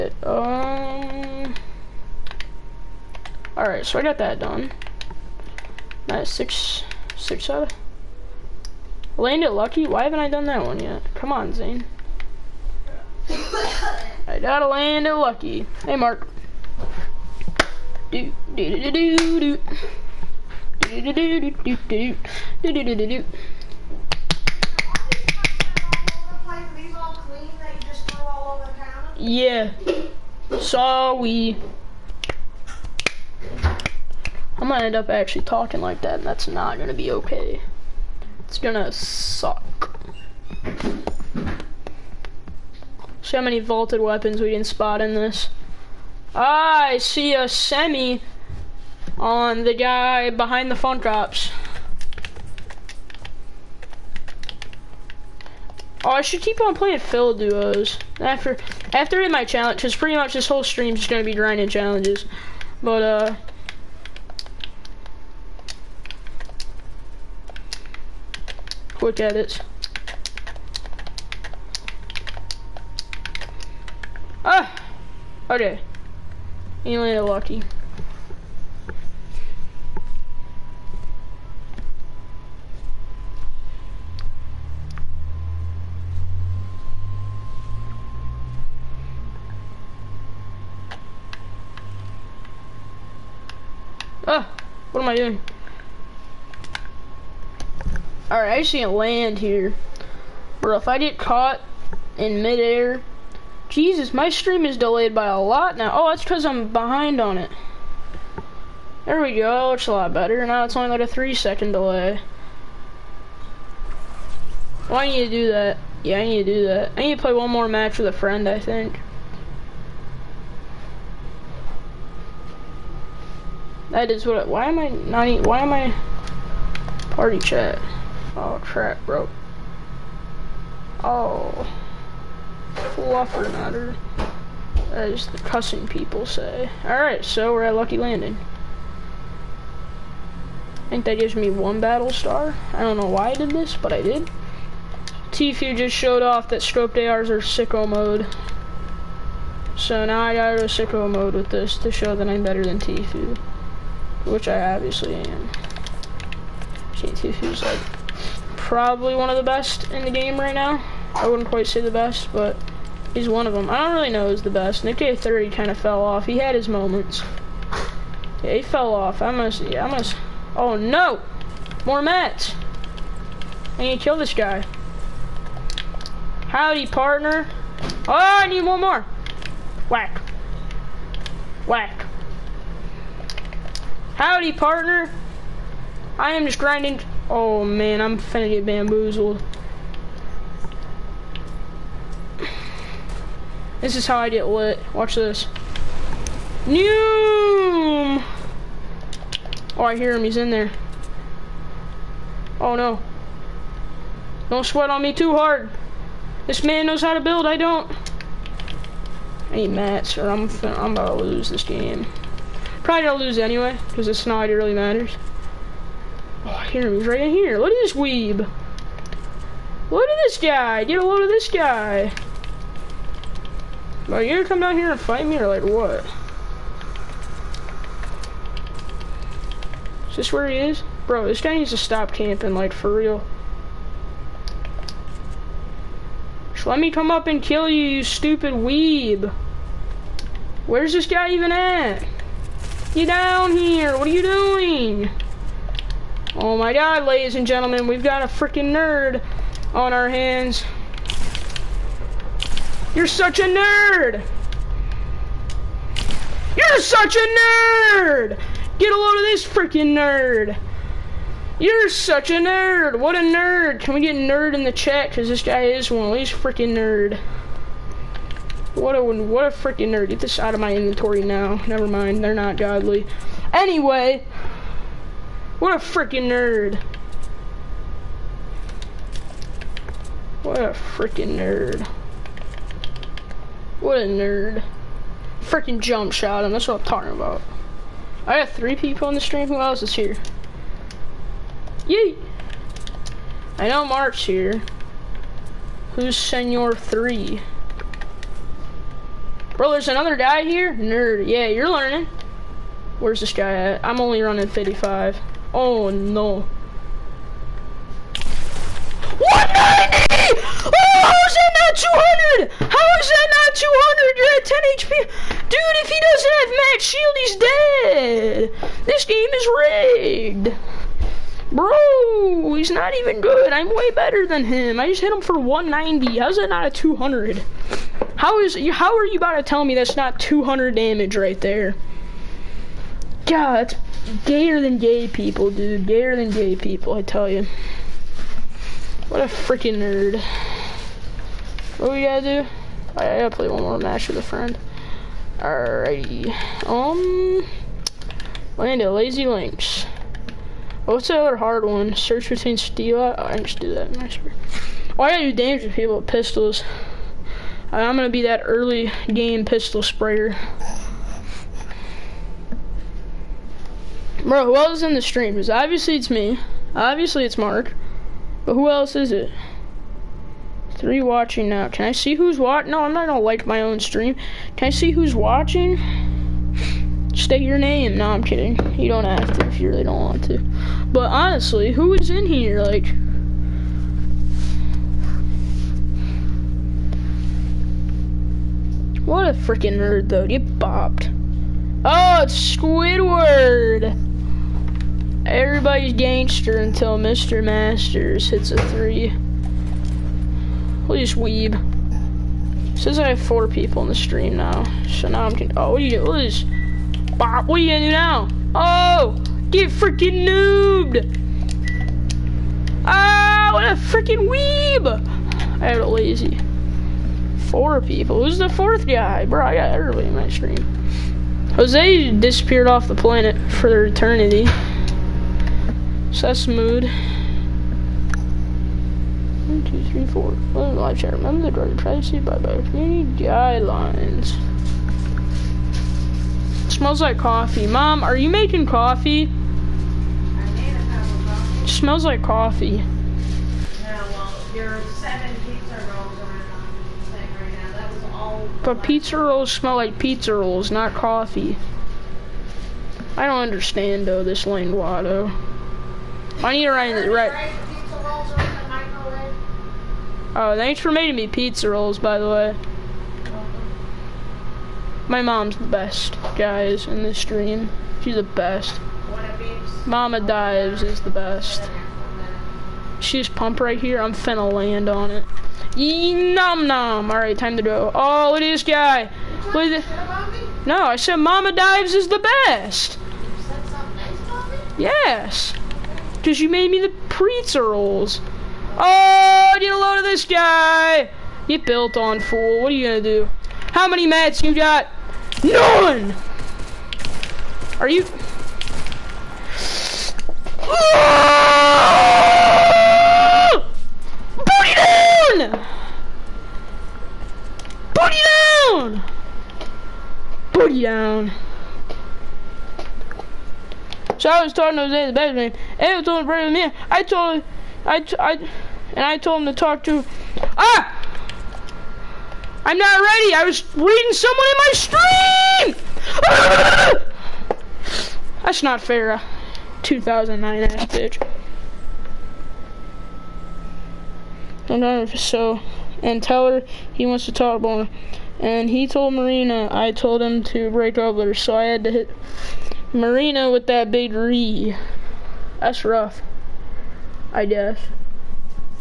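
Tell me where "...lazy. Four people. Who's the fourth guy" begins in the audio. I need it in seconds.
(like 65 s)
415 s.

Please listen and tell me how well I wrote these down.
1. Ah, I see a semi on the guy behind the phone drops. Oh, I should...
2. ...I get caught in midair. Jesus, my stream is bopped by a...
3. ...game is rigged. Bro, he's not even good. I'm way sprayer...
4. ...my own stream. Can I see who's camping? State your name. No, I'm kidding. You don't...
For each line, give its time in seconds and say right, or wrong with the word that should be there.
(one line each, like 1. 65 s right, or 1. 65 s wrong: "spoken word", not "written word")
1. 46 s right
2. 100 s wrong: "delayed", not "bopped"
3. 319 s wrong: "better", not "sprayer"
4. 373 s wrong: "watching", not "camping".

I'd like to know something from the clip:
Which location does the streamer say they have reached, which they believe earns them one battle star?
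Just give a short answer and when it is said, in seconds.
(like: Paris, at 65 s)
Lucky Landing, at 137 s.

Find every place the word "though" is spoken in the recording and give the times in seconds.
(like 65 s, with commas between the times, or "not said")
390 s, 454 s.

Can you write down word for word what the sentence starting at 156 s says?
See, Tfue's like probably one of the best in the game right now.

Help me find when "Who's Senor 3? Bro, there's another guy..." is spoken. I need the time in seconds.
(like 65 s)
295 s.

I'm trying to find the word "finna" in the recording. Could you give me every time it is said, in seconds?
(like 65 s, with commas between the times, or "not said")
188 s, 474 s.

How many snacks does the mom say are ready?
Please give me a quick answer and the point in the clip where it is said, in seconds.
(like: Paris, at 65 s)
7, at 444 s.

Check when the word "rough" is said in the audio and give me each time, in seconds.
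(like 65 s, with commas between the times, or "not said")
545 s.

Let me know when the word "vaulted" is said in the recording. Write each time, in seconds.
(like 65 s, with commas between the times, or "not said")
43 s.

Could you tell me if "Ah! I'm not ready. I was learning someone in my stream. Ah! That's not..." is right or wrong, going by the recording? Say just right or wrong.
wrong.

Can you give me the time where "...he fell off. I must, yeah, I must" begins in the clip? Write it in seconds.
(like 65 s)
168 s.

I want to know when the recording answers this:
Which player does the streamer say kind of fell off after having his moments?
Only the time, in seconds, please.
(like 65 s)
164 s.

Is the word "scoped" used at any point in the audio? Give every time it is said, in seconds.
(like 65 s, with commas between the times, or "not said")
146 s.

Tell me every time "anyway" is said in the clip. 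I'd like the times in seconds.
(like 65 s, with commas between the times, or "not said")
213 s, 273 s.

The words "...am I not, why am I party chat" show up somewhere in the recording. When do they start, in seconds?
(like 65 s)
124 s.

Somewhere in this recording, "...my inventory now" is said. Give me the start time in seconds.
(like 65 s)
270 s.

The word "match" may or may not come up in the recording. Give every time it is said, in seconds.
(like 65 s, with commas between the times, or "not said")
117 s, 209 s, 343 s.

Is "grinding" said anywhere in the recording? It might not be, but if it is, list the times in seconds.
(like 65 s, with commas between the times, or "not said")
61 s, 186 s.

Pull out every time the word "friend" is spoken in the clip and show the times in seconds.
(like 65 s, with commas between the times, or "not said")
118 s, 344 s.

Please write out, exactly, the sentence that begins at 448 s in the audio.
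But pizza rolls smell like pizza rolls, not coffee.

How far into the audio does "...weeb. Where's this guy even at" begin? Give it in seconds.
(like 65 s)
238 s.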